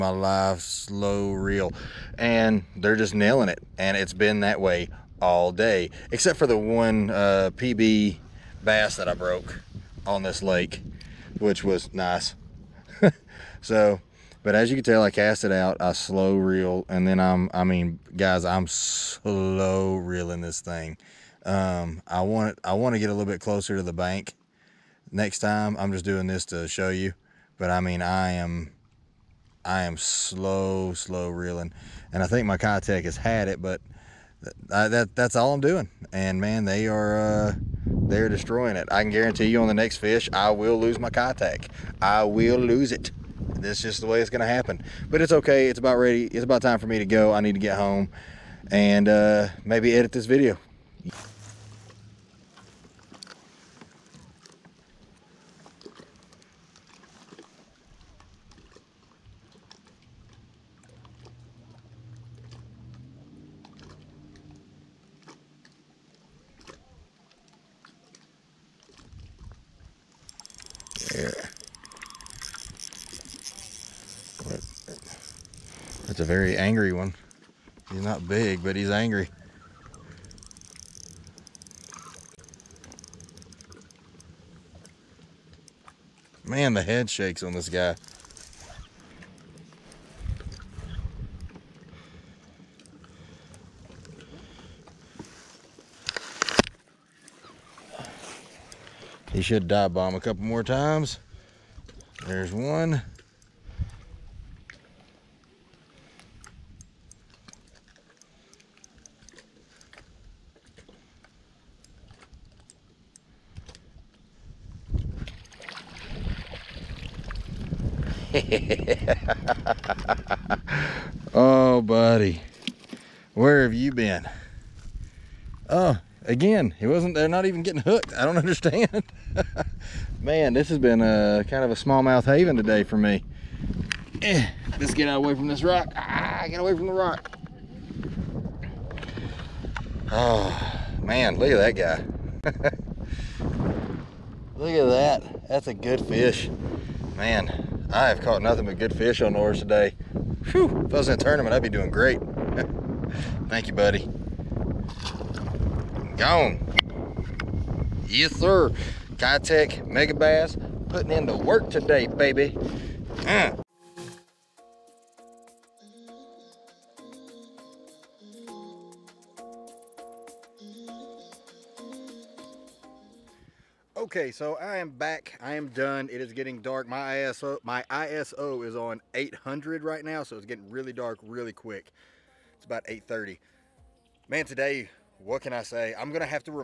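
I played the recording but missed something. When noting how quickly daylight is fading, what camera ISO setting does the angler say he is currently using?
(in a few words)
800.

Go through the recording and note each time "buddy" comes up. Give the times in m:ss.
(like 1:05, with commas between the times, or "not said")
2:01, 2:33.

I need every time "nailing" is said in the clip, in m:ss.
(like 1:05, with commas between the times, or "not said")
0:03.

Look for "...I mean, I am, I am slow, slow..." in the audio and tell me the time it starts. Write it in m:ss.
0:27.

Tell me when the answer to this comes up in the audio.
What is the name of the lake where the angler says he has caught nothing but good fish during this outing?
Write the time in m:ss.
2:29.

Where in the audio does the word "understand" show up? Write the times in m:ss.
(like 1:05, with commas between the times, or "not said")
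2:08.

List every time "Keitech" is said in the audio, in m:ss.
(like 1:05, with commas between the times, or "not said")
0:32, 0:41, 2:39.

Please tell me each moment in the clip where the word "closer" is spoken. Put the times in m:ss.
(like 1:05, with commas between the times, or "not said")
0:23.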